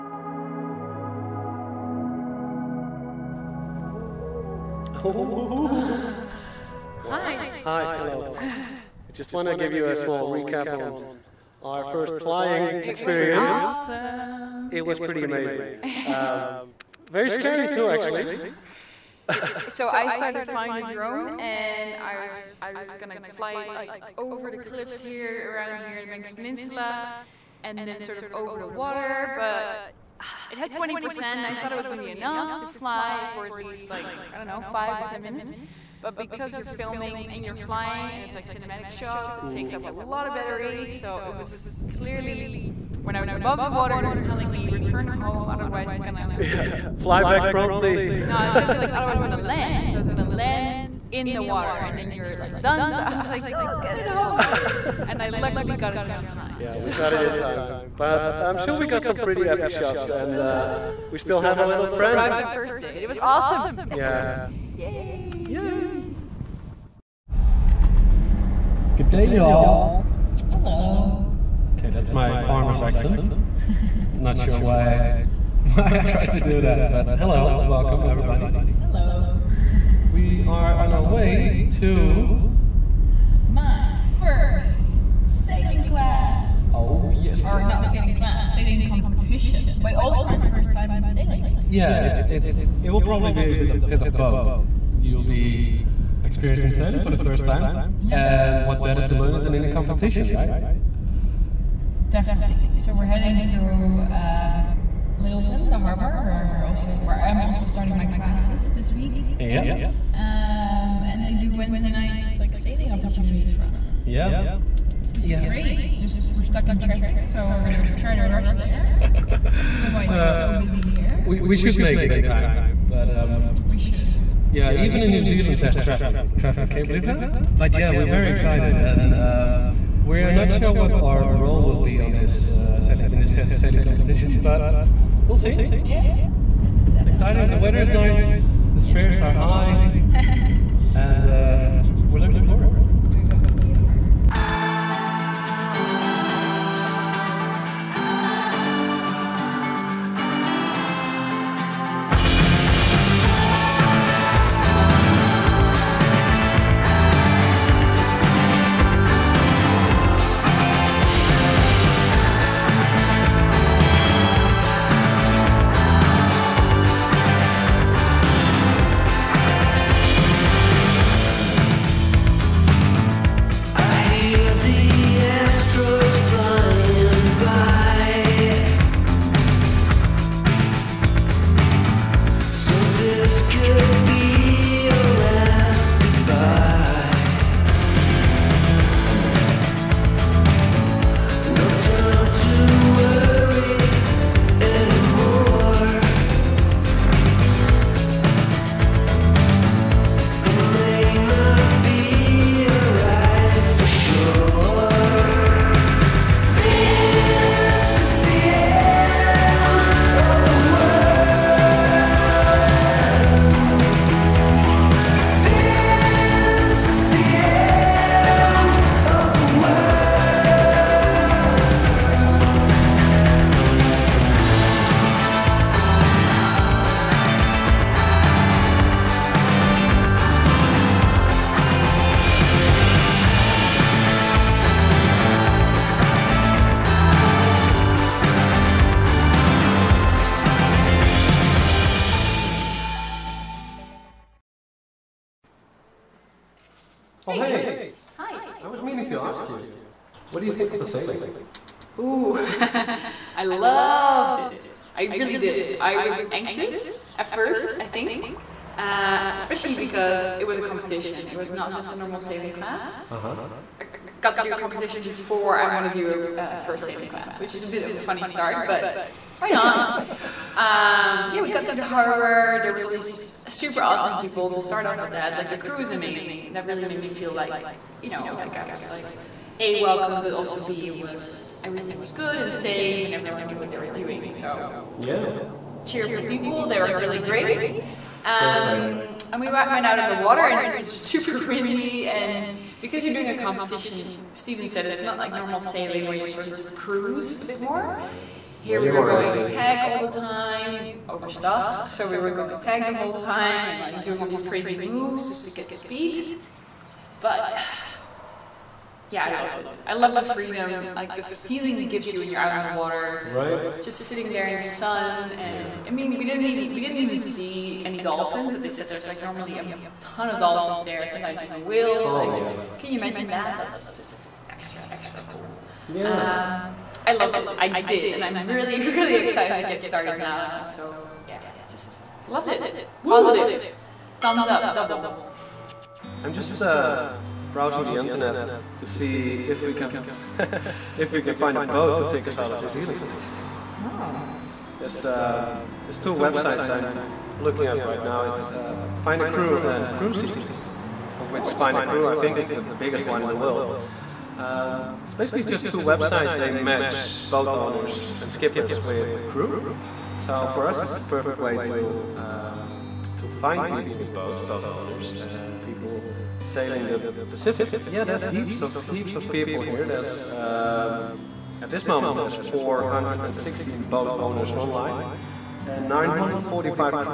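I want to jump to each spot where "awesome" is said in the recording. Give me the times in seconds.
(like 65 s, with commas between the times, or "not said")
13 s, 63 s, 273 s.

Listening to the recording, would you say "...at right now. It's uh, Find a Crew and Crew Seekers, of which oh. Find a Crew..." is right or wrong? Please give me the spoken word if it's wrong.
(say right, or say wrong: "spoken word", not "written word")
right.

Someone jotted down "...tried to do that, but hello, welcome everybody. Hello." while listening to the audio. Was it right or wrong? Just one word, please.
right.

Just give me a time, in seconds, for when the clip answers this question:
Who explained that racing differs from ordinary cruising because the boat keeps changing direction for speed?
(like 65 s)
294 s.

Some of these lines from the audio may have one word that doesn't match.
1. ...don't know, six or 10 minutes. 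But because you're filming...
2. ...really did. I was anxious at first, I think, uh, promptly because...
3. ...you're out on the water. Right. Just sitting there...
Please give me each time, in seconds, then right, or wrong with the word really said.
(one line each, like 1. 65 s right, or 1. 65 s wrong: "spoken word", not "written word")
1. 34 s wrong: "five", not "six"
2. 255 s wrong: "especially", not "promptly"
3. 312 s right.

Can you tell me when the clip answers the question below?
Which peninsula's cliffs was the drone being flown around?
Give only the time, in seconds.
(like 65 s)
26 s.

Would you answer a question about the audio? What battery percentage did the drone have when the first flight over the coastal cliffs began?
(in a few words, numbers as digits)
20%.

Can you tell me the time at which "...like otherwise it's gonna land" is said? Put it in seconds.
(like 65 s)
48 s.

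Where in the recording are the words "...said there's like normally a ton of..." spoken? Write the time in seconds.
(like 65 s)
318 s.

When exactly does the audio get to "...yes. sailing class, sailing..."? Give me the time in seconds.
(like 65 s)
87 s.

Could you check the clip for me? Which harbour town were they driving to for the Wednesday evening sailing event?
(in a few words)
Lyttelton.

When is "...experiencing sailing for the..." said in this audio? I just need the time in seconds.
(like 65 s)
96 s.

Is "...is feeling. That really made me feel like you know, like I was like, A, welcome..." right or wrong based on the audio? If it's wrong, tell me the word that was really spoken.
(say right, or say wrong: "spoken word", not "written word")
wrong: "amazing", not "feeling".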